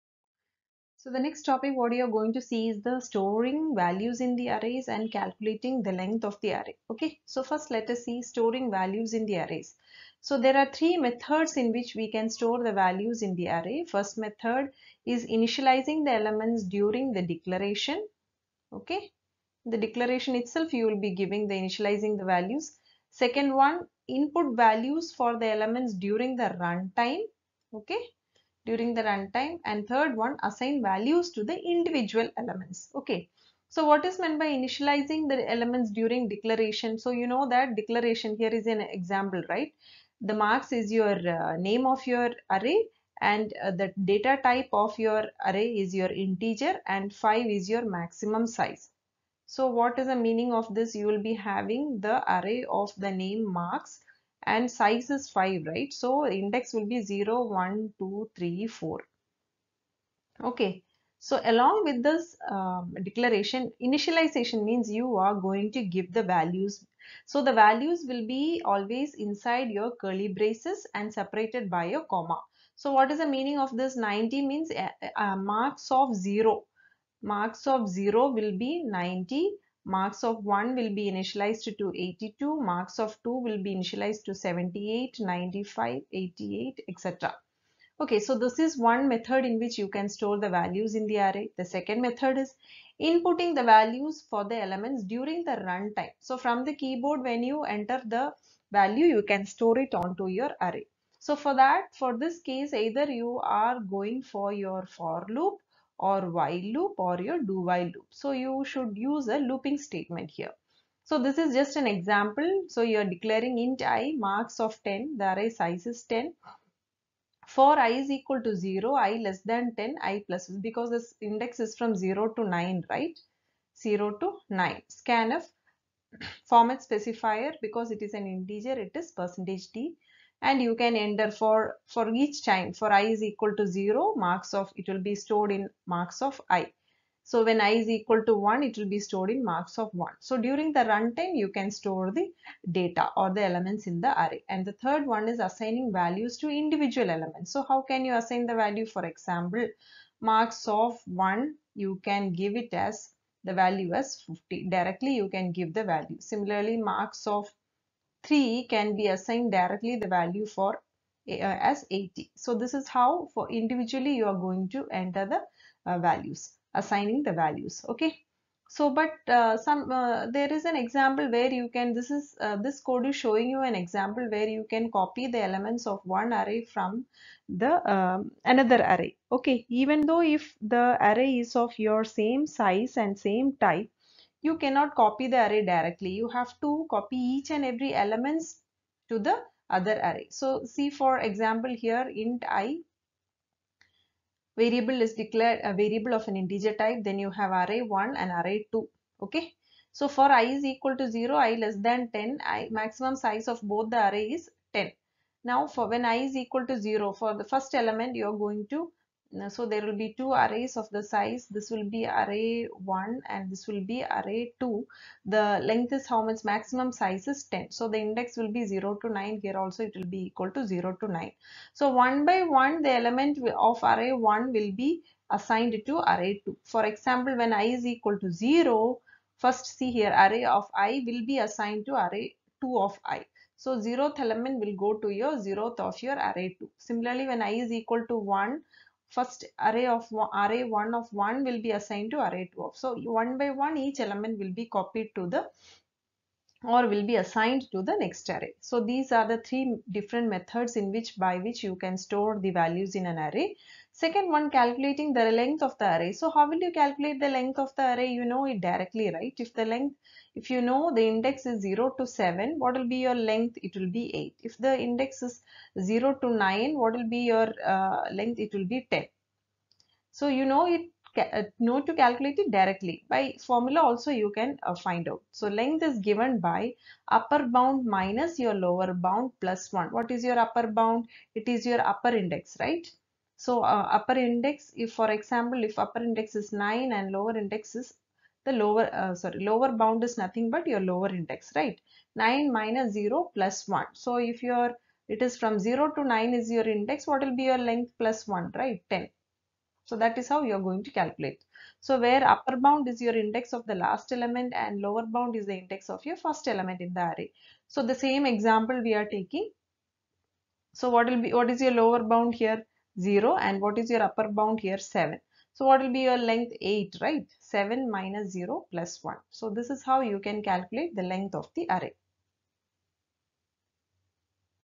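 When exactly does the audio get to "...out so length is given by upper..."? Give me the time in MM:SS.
04:35.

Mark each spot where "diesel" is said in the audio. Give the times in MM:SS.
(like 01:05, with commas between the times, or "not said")
not said.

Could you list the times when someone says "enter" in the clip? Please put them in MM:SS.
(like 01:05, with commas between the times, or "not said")
01:37, 02:10, 02:44.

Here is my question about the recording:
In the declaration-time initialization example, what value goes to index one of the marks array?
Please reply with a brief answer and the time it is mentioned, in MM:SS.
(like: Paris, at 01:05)
82, at 01:21.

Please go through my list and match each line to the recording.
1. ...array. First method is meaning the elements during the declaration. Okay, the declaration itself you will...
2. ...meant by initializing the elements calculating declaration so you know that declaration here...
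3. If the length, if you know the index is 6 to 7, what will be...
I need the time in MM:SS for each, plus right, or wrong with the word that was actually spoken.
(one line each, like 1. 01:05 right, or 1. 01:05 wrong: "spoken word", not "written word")
1. 00:13 wrong: "initializing", not "meaning"
2. 00:34 wrong: "during", not "calculating"
3. 04:19 wrong: "0", not "6".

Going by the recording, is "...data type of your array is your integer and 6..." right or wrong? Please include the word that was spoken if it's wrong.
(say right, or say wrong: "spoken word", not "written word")
wrong: "5", not "6".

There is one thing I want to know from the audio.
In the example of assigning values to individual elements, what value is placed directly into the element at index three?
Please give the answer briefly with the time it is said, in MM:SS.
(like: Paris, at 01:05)
80, at 02:41.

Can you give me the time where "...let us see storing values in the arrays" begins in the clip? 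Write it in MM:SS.
00:07.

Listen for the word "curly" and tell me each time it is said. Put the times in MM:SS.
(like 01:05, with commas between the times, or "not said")
01:10.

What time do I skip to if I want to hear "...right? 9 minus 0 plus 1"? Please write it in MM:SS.
04:51.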